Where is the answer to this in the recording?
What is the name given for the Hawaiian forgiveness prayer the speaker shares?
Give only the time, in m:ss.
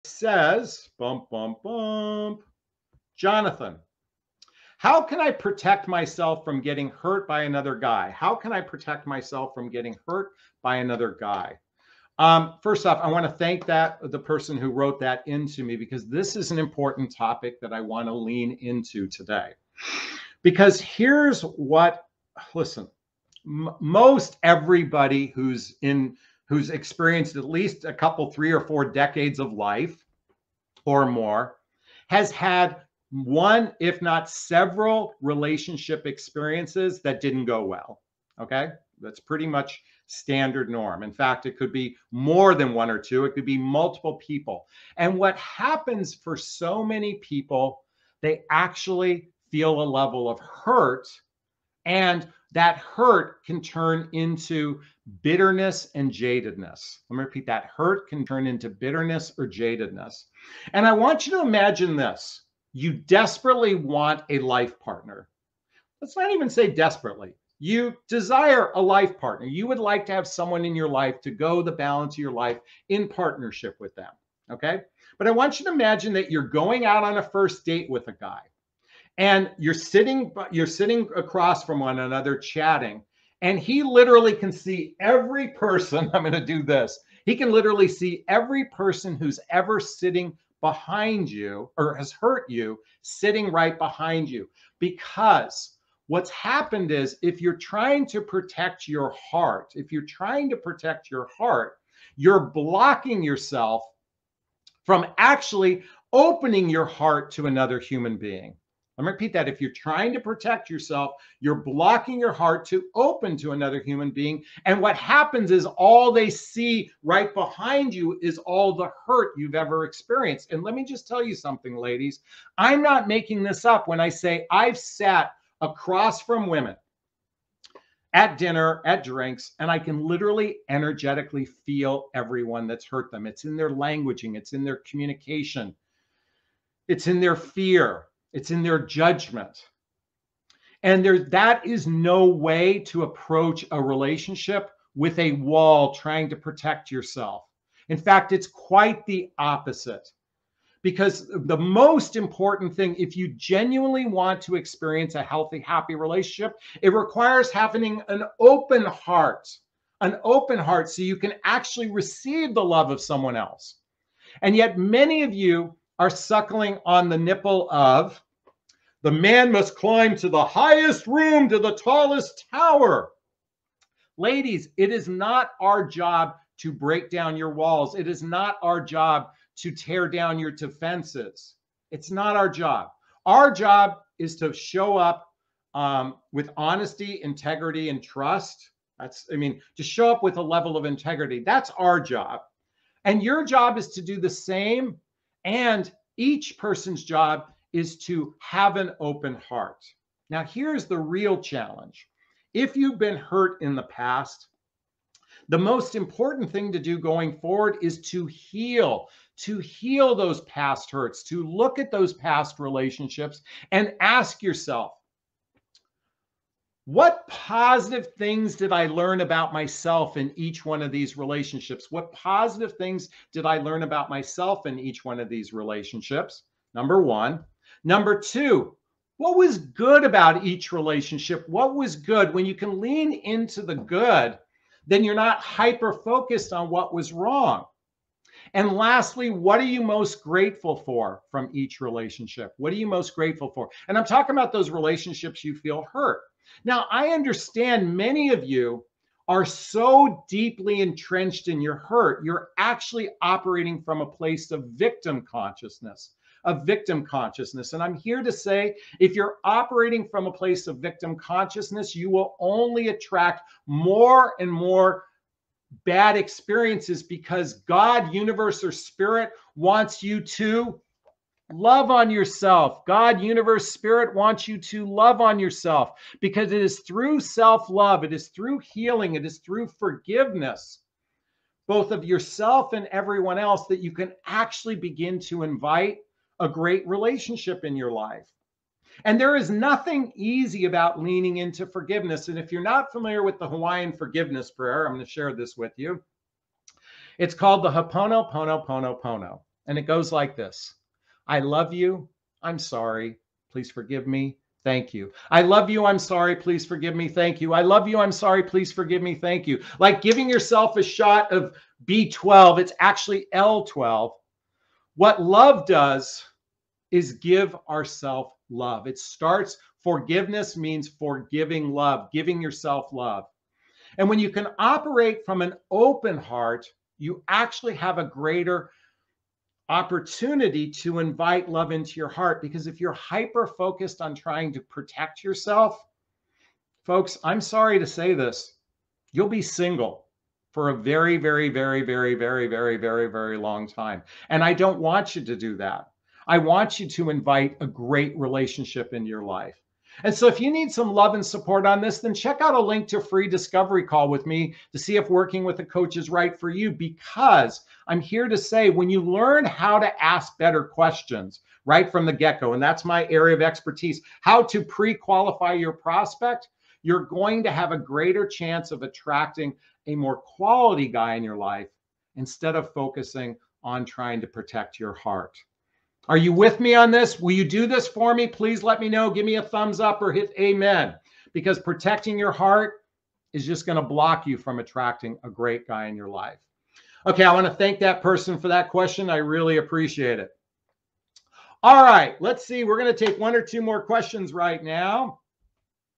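4:57.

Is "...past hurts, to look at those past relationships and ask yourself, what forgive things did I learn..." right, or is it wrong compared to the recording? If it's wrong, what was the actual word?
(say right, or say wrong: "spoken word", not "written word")
wrong: "positive", not "forgive".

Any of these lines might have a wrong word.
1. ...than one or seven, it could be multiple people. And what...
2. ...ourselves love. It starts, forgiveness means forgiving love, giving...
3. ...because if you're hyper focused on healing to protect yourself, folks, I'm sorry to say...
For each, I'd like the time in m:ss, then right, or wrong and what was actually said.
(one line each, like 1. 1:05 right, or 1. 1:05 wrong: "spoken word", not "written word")
1. 0:42 wrong: "two", not "seven"
2. 5:17 right
3. 5:32 wrong: "trying", not "healing".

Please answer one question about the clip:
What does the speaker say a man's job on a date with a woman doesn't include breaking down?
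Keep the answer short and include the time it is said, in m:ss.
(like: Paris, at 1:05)
your walls, at 2:57.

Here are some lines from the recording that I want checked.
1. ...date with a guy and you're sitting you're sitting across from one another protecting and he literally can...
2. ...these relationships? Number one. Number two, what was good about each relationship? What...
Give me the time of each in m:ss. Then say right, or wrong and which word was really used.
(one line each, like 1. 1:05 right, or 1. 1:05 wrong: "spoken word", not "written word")
1. 1:17 wrong: "chatting", not "protecting"
2. 3:45 right.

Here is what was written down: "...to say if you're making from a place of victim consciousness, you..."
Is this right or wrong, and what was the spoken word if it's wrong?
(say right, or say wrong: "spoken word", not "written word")
wrong: "operating", not "making".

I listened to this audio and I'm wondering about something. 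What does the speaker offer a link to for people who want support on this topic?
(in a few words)
a free discovery call.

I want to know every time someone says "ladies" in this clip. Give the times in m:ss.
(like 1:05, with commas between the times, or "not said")
2:01, 2:54.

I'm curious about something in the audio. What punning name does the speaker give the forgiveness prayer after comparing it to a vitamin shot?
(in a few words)
L12.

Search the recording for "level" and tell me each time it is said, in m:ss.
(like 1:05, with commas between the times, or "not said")
0:49, 3:10.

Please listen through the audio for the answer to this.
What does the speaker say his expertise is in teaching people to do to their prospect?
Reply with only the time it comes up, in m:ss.
6:04.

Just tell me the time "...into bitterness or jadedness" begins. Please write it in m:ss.
0:58.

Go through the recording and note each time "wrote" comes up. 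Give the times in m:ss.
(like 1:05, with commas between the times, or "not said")
0:14.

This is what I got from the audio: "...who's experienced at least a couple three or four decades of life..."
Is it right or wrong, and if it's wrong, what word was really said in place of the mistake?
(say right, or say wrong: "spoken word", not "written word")
right.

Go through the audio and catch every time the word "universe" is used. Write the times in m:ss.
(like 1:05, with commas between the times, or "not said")
4:28, 4:33.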